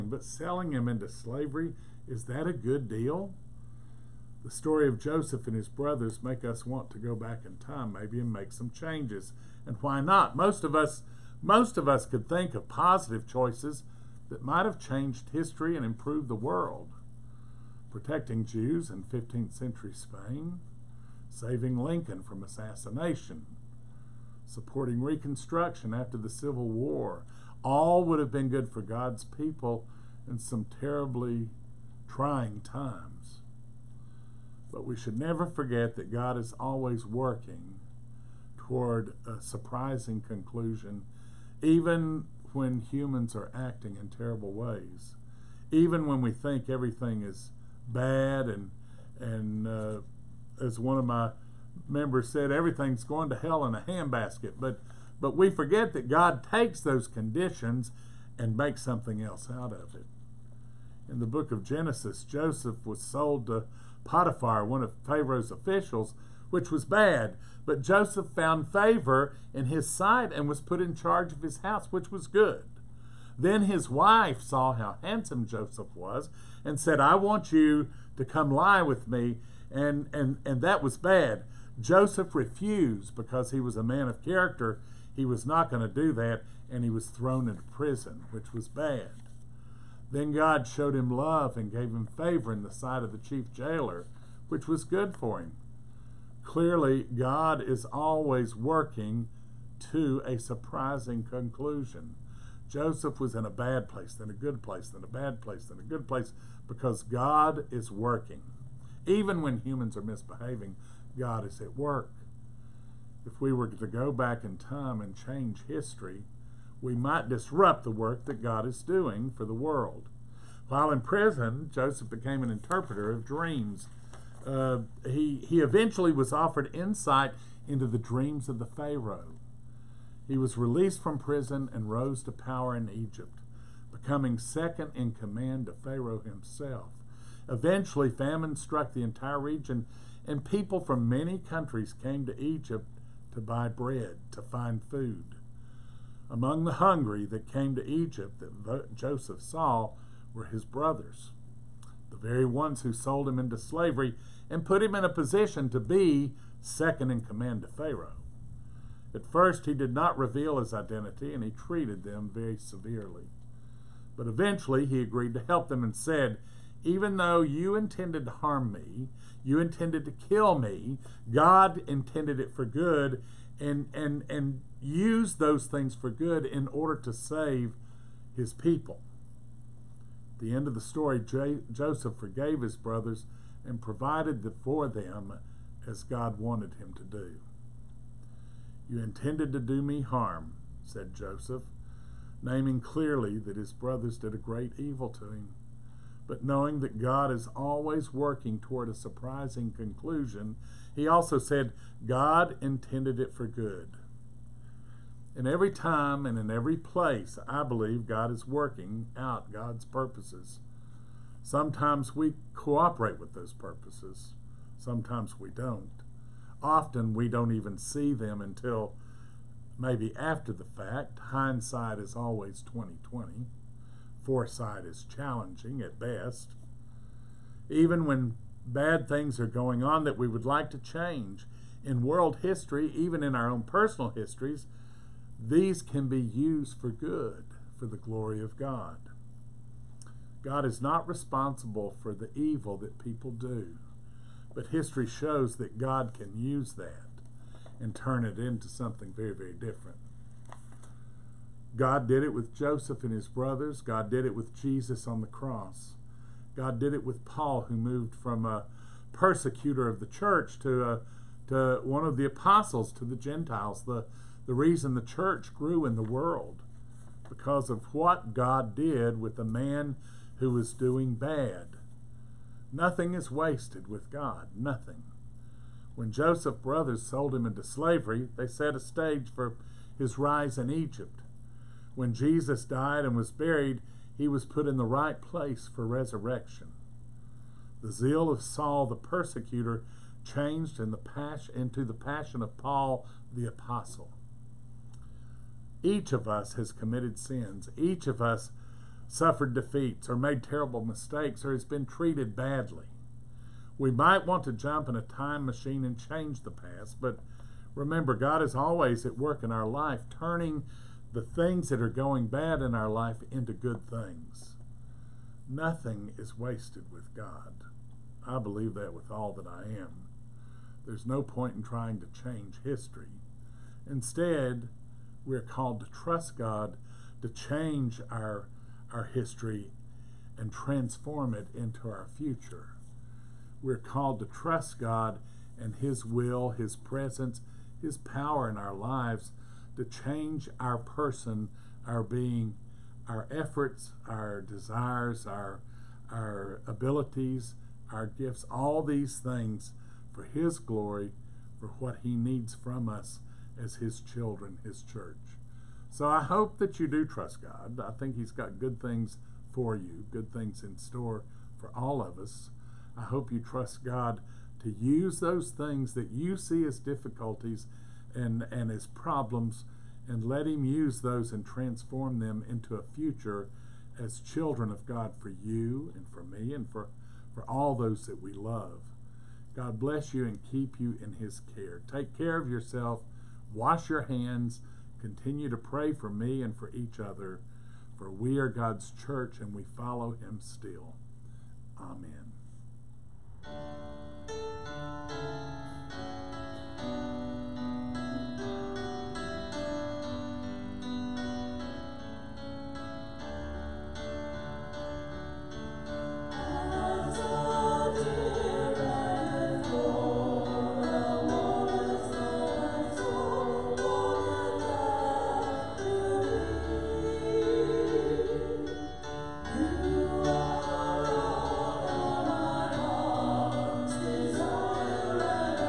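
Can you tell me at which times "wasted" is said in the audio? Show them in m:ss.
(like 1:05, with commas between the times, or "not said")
4:33, 5:16.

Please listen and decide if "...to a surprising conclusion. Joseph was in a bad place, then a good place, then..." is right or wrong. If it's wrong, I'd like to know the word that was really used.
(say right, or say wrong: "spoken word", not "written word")
right.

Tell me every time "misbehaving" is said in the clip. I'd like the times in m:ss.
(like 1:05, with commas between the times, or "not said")
1:50.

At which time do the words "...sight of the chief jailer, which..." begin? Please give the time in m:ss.
1:32.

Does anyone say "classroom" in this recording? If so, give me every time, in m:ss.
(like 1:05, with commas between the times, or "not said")
not said.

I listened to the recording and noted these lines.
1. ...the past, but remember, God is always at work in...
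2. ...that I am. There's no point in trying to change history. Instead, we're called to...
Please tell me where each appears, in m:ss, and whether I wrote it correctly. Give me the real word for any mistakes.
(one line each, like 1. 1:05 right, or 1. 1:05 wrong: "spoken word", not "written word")
1. 5:06 right
2. 5:19 right.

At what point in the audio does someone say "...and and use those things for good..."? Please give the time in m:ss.
2:53.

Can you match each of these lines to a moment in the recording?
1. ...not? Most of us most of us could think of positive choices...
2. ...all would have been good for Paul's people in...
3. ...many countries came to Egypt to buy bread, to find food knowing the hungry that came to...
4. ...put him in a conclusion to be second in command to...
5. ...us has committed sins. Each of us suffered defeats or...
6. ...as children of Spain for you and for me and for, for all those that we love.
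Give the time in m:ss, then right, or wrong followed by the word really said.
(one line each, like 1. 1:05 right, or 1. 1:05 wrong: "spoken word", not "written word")
1. 0:10 right
2. 0:27 wrong: "God", not "Paul"
3. 2:21 wrong: "among", not "knowing"
4. 2:34 wrong: "position", not "conclusion"
5. 4:56 right
6. 6:13 wrong: "God", not "Spain".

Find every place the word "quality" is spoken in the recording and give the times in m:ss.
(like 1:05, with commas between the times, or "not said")
not said.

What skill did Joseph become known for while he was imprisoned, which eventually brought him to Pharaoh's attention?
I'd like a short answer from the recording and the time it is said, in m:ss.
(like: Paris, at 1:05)
interpreter of dreams, at 2:02.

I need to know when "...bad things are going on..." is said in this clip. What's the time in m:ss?
3:48.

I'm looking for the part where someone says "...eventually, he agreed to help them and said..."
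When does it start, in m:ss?
2:44.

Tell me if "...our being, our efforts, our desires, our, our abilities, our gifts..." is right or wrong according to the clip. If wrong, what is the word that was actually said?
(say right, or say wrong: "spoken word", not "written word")
right.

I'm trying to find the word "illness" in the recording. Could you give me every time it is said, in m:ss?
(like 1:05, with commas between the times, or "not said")
not said.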